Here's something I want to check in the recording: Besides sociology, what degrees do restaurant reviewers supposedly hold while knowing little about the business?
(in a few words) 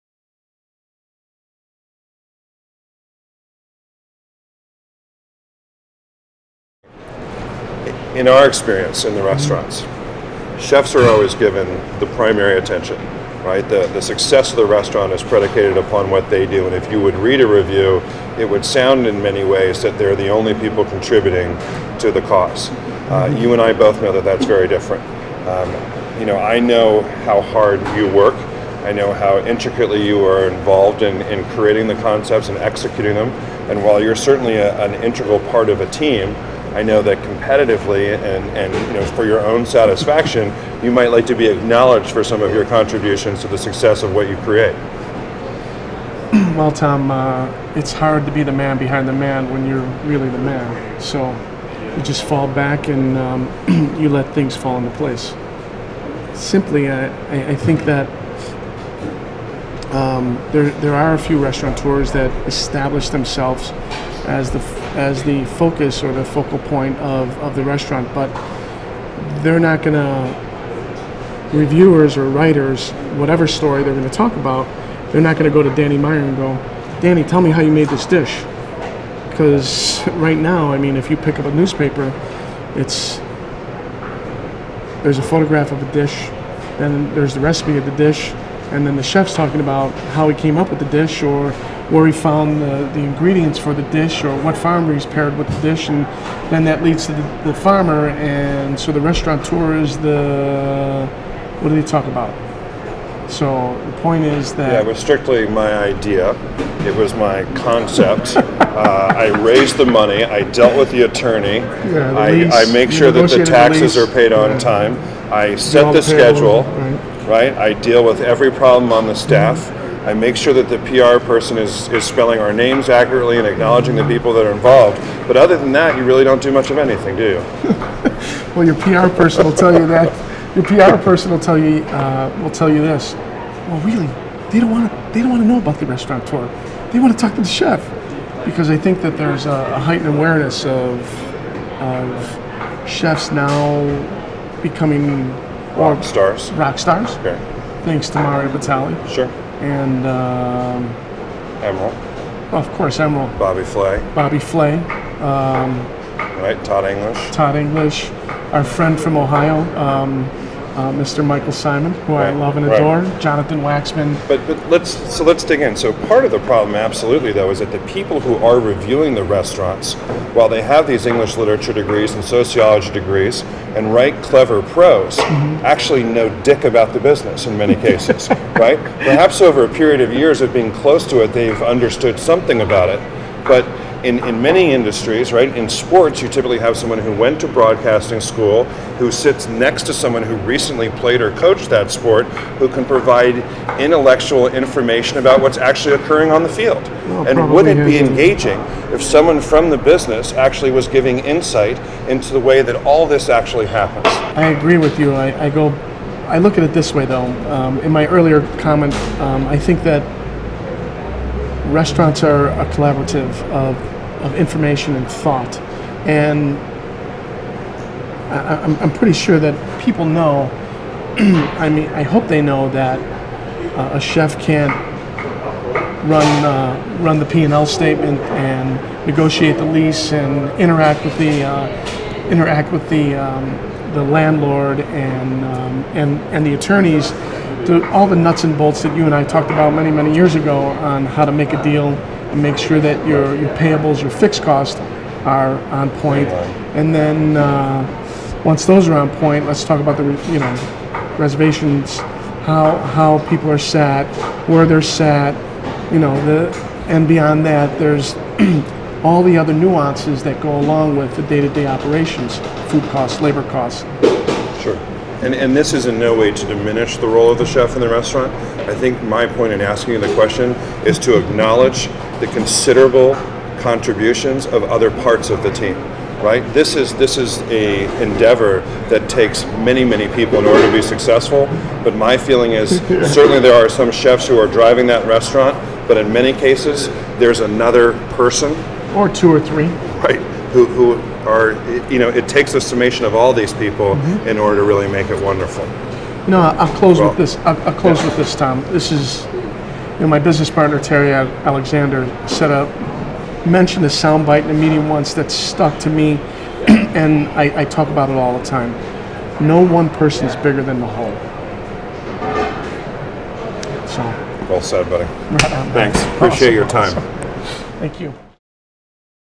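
English literature.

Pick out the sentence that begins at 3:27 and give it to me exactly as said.
Um, in my earlier comment, um, I think that restaurants are a collaborative of, of information and thought.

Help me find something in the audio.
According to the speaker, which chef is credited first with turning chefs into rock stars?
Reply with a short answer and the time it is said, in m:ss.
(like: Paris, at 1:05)
Mario Batali, at 2:28.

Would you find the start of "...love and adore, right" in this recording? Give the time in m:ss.
2:42.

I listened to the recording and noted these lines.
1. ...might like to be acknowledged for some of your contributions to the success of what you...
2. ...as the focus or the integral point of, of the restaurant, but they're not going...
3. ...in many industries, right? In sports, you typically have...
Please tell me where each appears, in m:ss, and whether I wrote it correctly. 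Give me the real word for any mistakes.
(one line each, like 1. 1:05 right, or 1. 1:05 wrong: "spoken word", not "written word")
1. 0:40 right
2. 1:04 wrong: "focal", not "integral"
3. 3:04 right.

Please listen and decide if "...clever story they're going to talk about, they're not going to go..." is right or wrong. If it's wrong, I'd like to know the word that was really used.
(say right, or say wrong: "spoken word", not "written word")
wrong: "whatever", not "clever".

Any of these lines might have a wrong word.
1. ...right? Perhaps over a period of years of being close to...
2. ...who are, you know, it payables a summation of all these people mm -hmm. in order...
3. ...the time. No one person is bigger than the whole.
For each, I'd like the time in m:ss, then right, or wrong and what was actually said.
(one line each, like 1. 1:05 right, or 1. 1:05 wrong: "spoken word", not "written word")
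1. 2:58 right
2. 4:50 wrong: "takes", not "payables"
3. 5:08 right.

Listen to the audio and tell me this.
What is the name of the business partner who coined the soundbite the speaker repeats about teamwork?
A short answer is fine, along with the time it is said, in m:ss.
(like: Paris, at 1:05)
Terry Alexander, at 5:00.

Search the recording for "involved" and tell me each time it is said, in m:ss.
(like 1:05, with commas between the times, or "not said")
0:30, 2:04.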